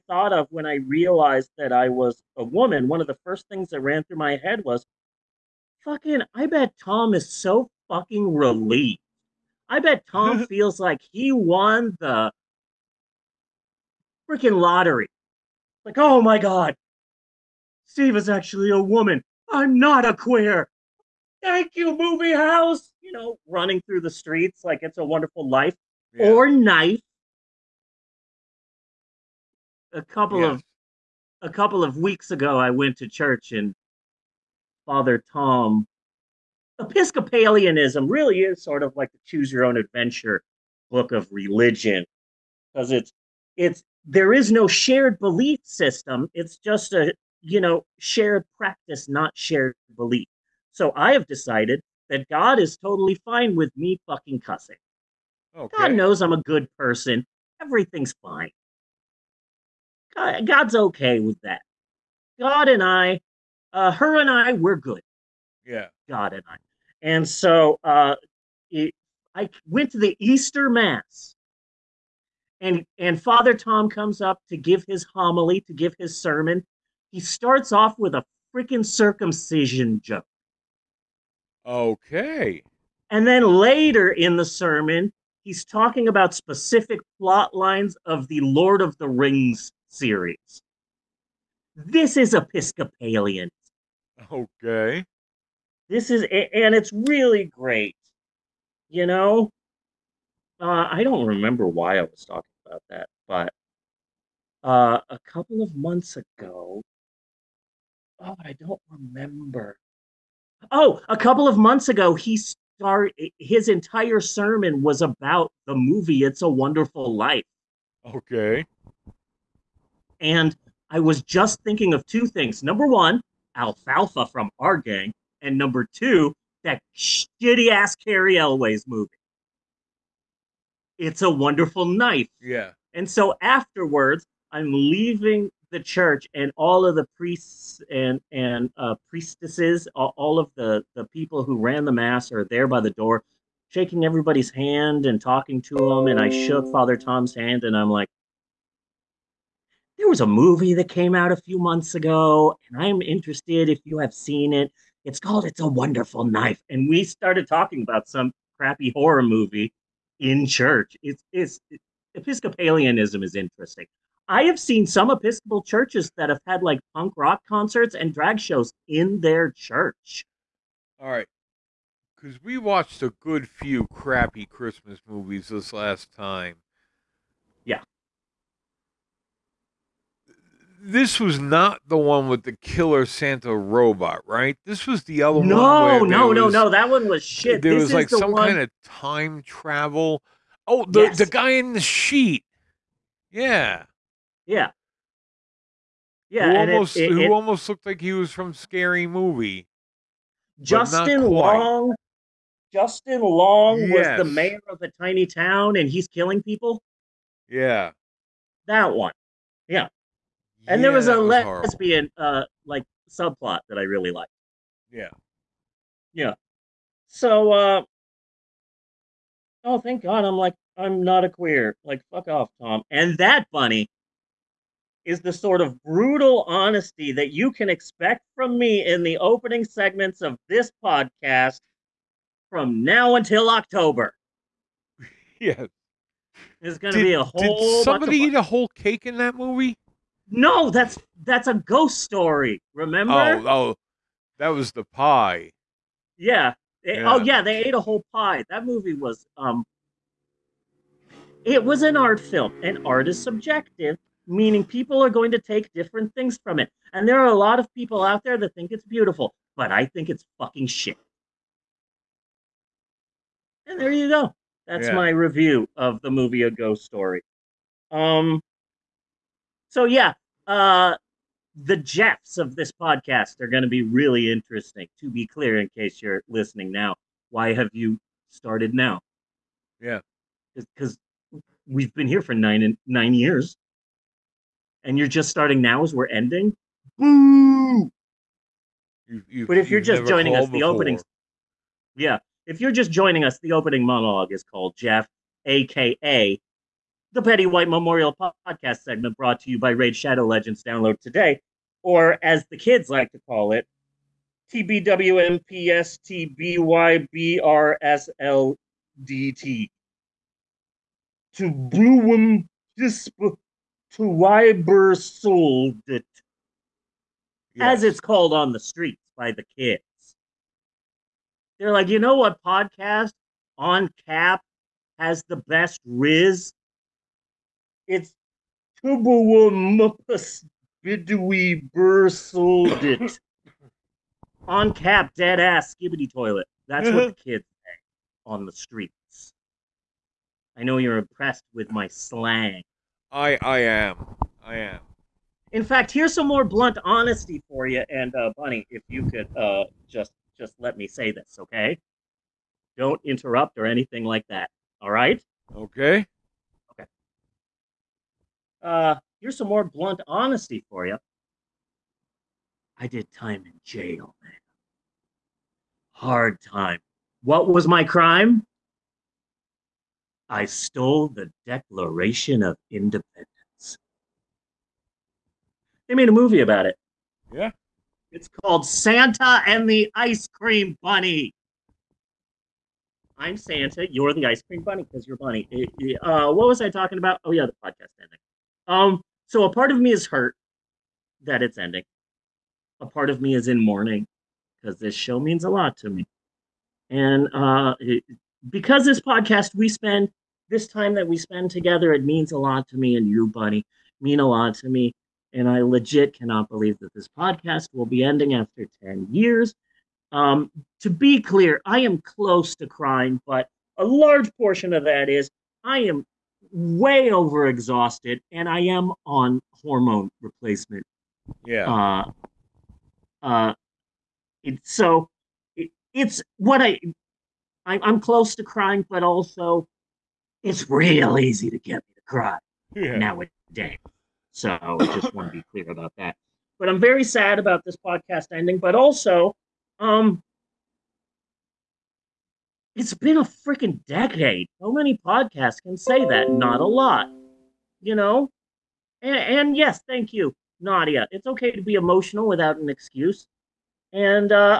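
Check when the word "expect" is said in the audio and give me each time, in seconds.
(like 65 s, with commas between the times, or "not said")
227 s.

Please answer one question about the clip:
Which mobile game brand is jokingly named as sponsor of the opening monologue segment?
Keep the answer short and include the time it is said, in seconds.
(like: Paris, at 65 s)
Raid Shadow Legends, at 299 s.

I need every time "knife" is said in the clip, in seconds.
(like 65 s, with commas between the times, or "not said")
26 s, 131 s, 156 s.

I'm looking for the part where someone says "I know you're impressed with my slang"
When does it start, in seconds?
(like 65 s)
340 s.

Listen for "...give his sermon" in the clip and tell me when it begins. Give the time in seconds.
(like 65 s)
75 s.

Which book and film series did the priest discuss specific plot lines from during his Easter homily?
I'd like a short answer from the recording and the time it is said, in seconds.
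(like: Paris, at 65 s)
Lord of the Rings, at 88 s.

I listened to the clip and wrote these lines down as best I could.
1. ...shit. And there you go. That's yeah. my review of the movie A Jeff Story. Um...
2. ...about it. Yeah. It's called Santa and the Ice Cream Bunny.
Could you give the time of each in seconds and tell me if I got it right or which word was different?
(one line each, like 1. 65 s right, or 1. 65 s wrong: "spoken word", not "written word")
1. 260 s wrong: "Ghost", not "Jeff"
2. 376 s right.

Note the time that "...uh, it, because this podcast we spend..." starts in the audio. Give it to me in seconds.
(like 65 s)
397 s.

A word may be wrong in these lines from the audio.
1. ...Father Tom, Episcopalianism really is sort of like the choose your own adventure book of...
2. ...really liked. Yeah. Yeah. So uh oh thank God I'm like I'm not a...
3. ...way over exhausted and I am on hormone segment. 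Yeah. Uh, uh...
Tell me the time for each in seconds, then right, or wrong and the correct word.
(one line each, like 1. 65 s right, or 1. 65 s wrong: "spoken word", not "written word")
1. 34 s right
2. 213 s right
3. 416 s wrong: "replacement", not "segment".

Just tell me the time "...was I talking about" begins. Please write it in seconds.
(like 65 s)
386 s.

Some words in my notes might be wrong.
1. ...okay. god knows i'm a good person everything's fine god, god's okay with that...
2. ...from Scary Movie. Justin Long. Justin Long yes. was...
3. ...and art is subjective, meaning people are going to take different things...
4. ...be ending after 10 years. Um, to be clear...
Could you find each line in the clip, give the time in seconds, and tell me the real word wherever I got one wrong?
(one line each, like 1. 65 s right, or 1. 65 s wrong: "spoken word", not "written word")
1. 55 s right
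2. 198 s right
3. 252 s right
4. 407 s right.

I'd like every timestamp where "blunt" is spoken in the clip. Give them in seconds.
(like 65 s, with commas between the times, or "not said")
346 s, 359 s.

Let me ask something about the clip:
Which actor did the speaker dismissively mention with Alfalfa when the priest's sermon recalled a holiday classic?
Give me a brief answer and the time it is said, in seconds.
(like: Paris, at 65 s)
Cary Elwes, at 127 s.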